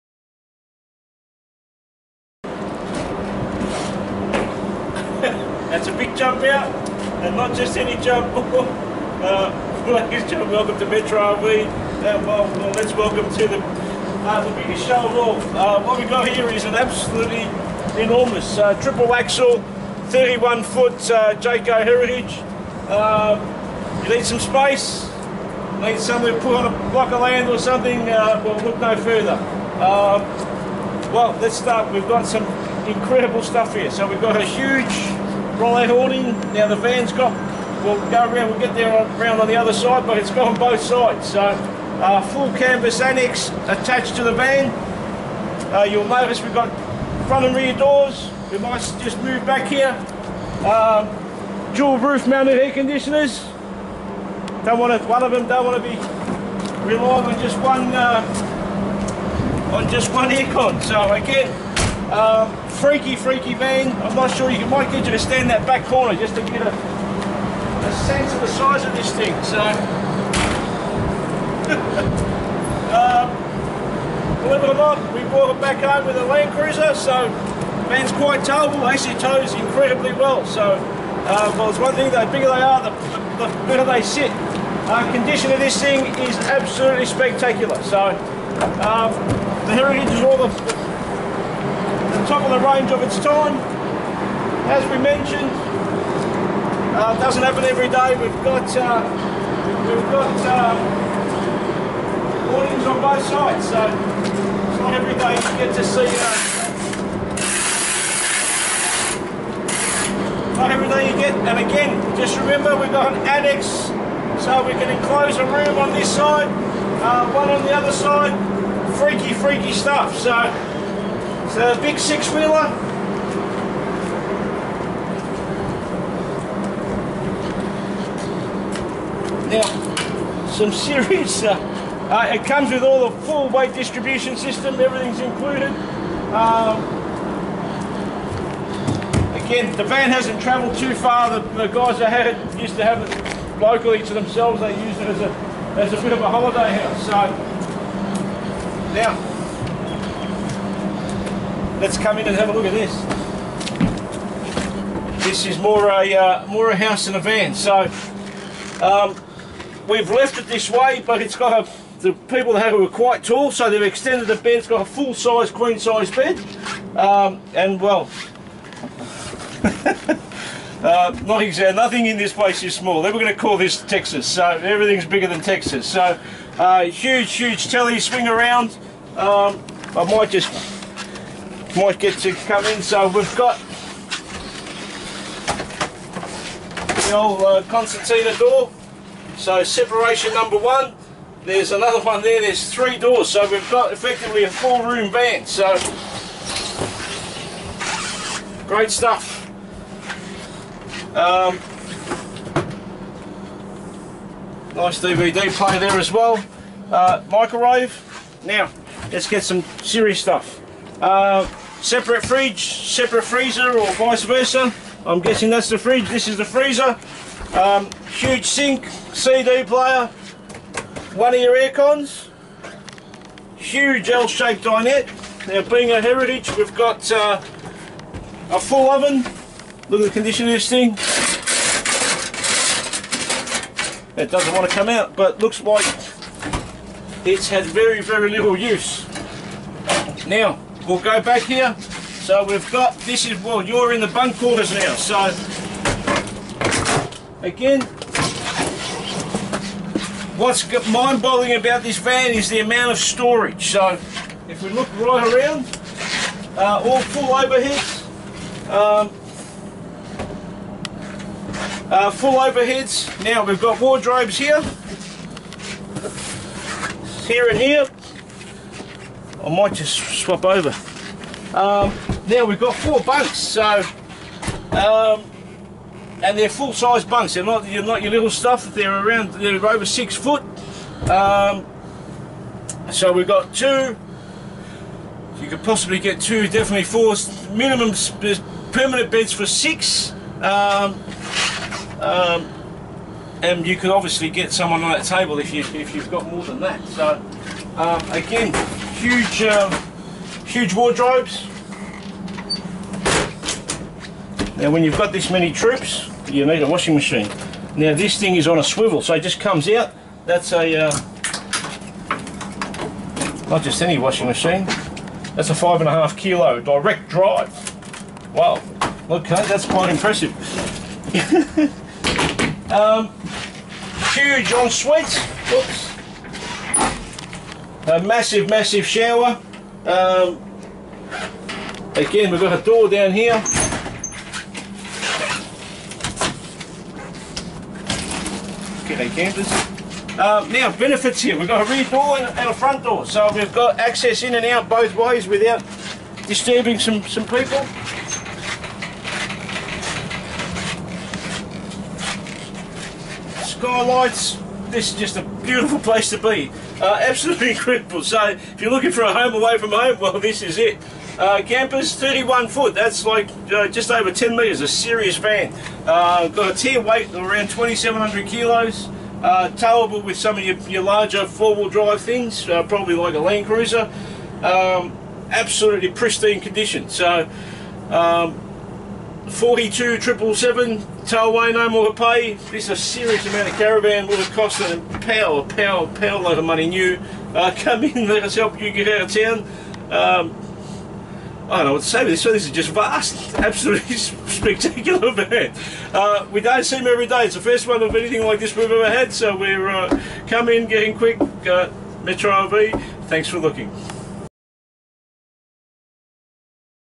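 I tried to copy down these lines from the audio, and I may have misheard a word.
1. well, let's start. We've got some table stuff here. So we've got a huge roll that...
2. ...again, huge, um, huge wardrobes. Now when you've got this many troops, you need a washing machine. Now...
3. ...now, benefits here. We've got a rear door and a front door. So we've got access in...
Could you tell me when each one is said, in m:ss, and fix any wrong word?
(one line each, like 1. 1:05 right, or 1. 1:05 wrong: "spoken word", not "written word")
1. 0:31 wrong: "incredible", not "table"
2. 4:58 right
3. 5:40 right.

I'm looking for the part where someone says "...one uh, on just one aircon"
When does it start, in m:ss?
0:57.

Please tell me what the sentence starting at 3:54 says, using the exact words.
It doesn't want to come out, but looks like it's had very, very little use.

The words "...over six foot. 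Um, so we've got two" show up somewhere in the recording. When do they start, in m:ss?
4:39.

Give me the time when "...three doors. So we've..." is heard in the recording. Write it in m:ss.
3:12.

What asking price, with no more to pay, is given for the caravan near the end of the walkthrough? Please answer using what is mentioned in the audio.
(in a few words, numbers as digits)
$42,777.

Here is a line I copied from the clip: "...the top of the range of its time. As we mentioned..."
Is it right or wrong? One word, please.
right.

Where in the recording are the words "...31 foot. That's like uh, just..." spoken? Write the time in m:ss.
6:01.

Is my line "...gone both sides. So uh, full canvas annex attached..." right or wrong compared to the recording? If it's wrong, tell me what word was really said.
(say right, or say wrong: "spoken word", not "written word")
right.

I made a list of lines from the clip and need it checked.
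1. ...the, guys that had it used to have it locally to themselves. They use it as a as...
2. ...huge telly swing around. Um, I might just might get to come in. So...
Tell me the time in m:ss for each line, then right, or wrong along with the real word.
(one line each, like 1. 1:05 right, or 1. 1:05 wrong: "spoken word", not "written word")
1. 2:21 right
2. 2:57 right.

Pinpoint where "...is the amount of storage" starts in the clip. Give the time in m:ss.
4:12.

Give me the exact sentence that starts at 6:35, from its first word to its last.
Uh, we don't see them every day.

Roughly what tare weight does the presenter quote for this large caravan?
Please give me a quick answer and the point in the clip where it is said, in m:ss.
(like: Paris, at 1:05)
2,700 kilos, at 6:07.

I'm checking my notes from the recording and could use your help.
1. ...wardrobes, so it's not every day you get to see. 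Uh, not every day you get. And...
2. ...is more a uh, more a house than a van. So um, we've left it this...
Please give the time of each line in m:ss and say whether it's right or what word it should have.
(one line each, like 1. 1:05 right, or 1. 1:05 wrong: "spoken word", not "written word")
1. 1:43 wrong: "sides", not "wardrobes"
2. 2:35 right.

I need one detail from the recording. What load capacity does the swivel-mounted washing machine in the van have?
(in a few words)
5.5 kilos.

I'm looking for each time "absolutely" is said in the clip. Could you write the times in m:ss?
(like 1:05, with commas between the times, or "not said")
0:16, 1:26, 5:57, 6:15, 6:33.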